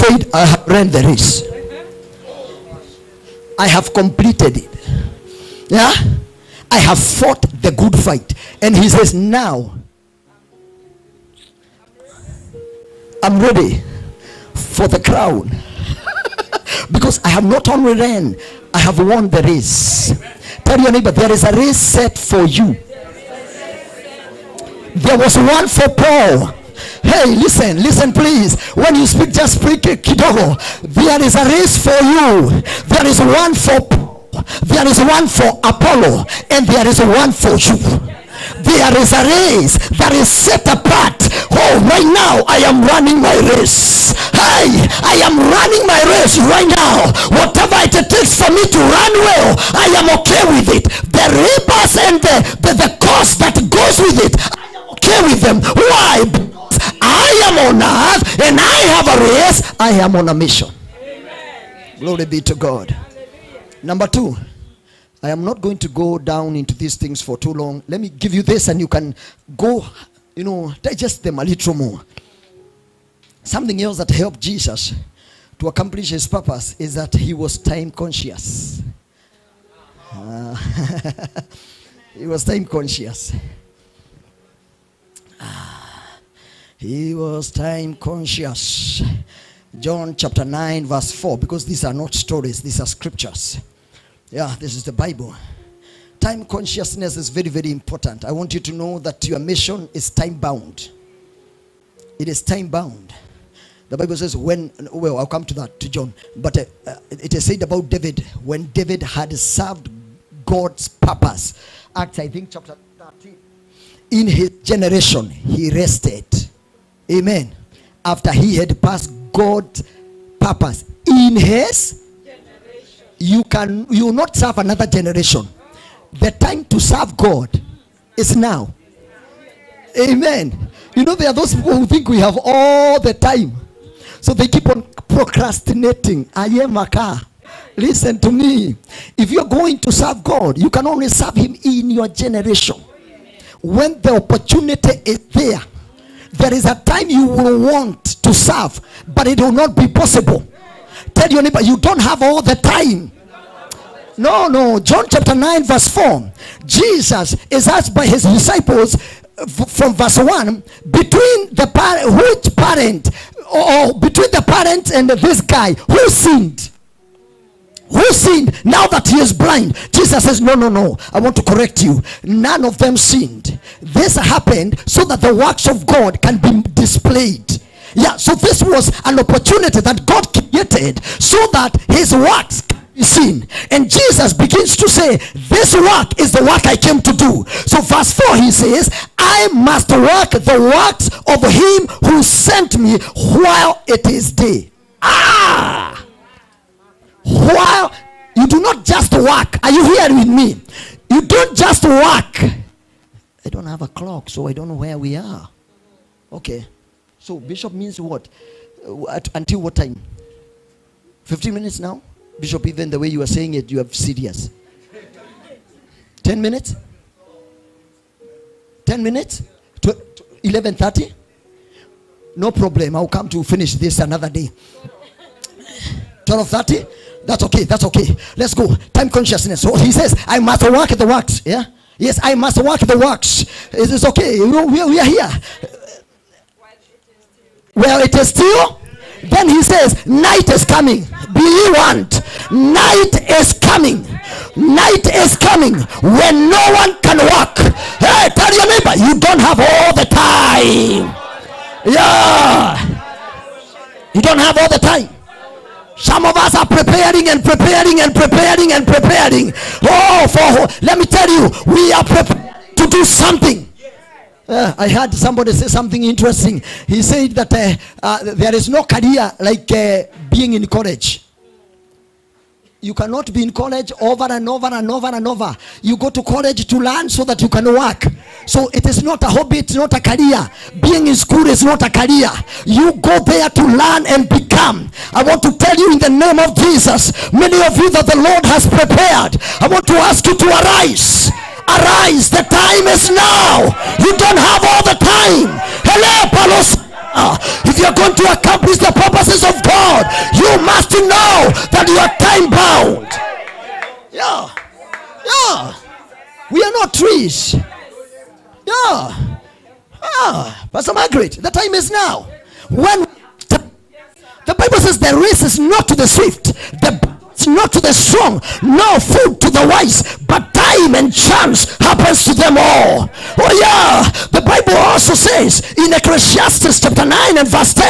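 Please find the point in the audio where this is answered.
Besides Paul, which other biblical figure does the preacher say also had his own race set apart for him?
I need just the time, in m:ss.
0:35.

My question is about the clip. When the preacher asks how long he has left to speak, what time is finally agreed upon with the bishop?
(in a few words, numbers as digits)
12:30.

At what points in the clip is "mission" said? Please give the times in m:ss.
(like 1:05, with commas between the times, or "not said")
1:00, 1:39.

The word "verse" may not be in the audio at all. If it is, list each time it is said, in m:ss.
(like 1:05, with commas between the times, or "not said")
1:30, 2:35, 2:39, 3:07.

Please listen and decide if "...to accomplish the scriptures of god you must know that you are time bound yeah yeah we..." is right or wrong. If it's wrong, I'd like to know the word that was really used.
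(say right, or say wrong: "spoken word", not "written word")
wrong: "purposes", not "scriptures".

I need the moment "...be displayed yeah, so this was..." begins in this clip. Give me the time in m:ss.
2:56.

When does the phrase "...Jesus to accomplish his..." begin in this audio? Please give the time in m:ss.
1:14.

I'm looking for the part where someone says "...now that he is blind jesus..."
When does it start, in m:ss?
2:48.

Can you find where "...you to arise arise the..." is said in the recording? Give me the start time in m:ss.
4:50.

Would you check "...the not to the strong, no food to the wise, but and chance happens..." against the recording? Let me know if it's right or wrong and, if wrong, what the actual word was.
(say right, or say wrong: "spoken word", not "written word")
right.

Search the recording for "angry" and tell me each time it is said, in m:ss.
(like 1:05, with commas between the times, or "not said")
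not said.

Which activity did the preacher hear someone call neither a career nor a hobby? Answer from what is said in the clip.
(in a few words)
Being in school.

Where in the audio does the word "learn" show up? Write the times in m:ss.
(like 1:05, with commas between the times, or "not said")
4:36, 4:43.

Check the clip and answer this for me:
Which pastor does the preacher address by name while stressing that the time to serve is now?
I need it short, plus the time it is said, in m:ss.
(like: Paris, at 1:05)
Pastor Margaret, at 5:10.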